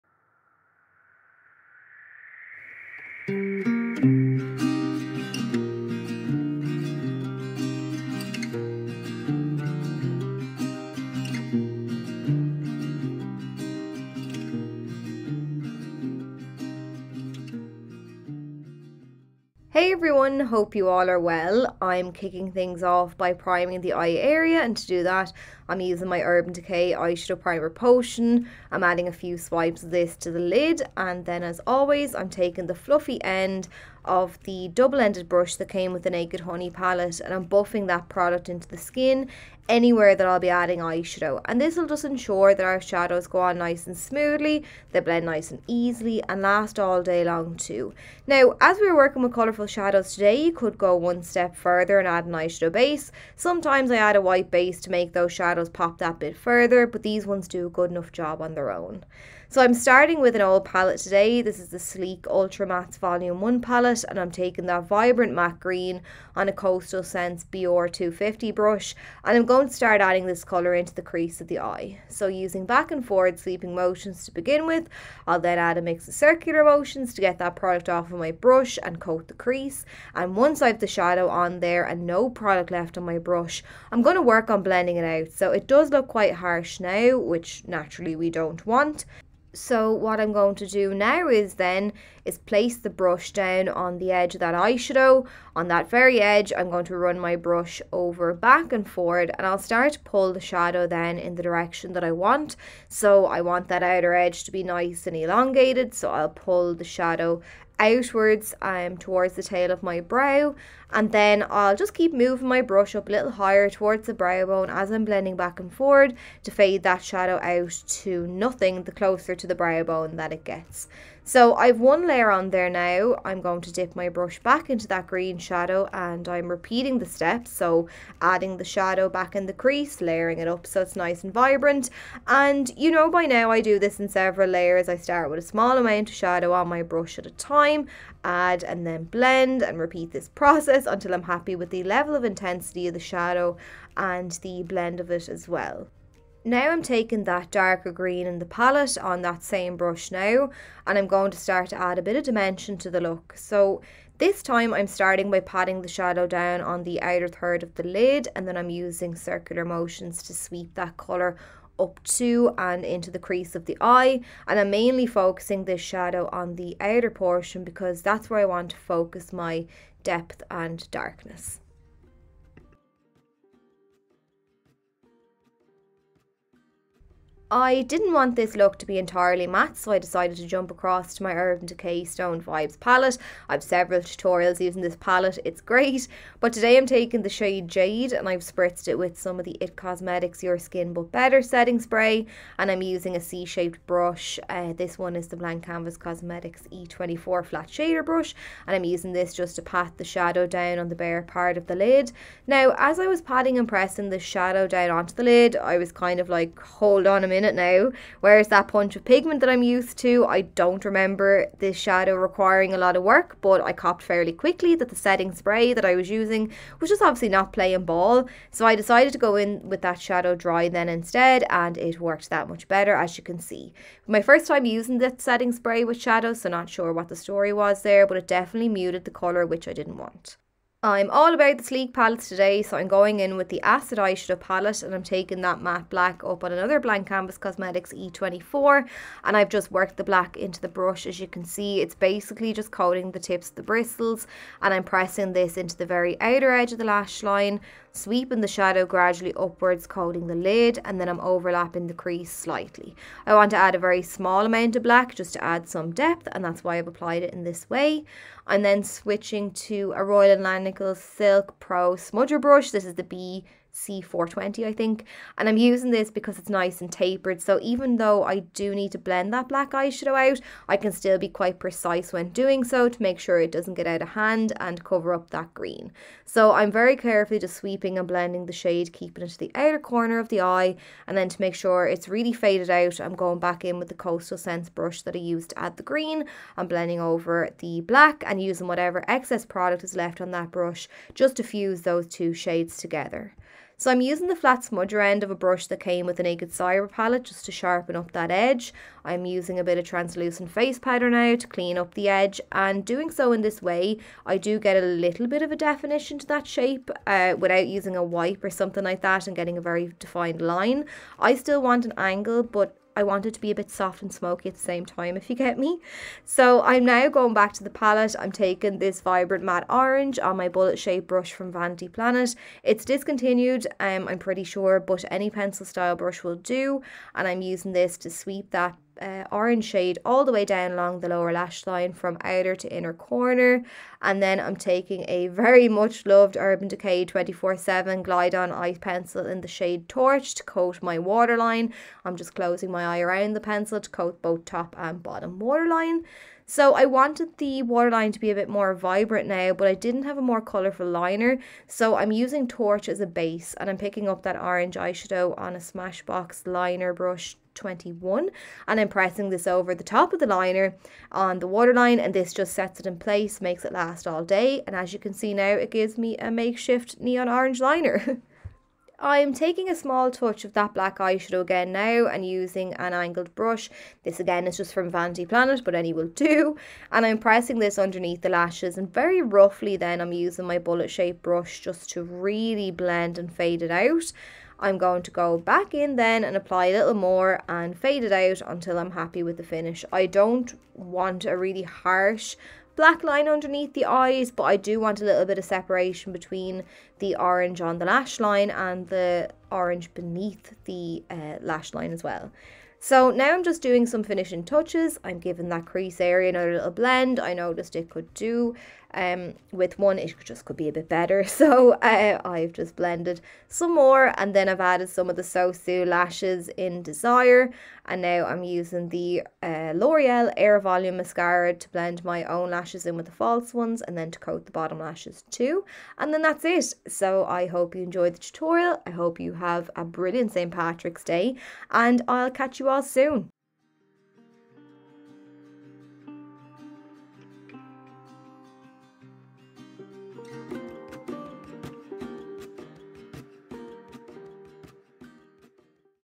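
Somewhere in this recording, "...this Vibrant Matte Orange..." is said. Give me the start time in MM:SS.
05:18.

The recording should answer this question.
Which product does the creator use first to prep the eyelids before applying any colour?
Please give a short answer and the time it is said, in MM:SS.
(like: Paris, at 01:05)
Urban Decay Eyeshadow Primer Potion, at 00:26.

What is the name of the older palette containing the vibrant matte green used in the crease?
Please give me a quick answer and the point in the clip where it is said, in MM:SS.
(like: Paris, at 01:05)
Sleek Ultra Mattes Volume 1, at 01:01.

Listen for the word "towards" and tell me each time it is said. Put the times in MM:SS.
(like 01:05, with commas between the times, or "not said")
01:48, 01:53.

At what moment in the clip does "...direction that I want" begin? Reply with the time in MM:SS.
01:41.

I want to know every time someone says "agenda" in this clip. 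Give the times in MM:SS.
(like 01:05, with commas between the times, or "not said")
not said.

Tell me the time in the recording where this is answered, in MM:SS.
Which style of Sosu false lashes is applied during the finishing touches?
06:56.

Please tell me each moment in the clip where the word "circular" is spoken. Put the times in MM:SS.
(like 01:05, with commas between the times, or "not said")
01:16, 02:39.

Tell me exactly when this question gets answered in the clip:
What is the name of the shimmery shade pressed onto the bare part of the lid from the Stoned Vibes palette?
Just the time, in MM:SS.
03:07.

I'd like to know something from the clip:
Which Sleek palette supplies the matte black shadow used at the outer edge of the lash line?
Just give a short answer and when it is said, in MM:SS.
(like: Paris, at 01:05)
Acid Eyeshadow palette, at 03:53.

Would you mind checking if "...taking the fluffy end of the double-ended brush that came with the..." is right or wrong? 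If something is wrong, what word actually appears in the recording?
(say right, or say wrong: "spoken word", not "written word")
right.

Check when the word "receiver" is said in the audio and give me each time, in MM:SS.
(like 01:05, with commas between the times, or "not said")
not said.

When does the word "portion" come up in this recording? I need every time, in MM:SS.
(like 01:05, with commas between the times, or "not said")
02:47.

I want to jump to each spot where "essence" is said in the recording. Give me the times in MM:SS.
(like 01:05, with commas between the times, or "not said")
not said.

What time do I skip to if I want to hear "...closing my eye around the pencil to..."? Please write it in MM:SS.
05:42.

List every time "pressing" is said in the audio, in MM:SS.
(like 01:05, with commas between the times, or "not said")
03:23, 04:04, 05:58, 06:17.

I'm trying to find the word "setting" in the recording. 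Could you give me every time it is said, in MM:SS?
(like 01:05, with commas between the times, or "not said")
03:11, 03:34, 03:45.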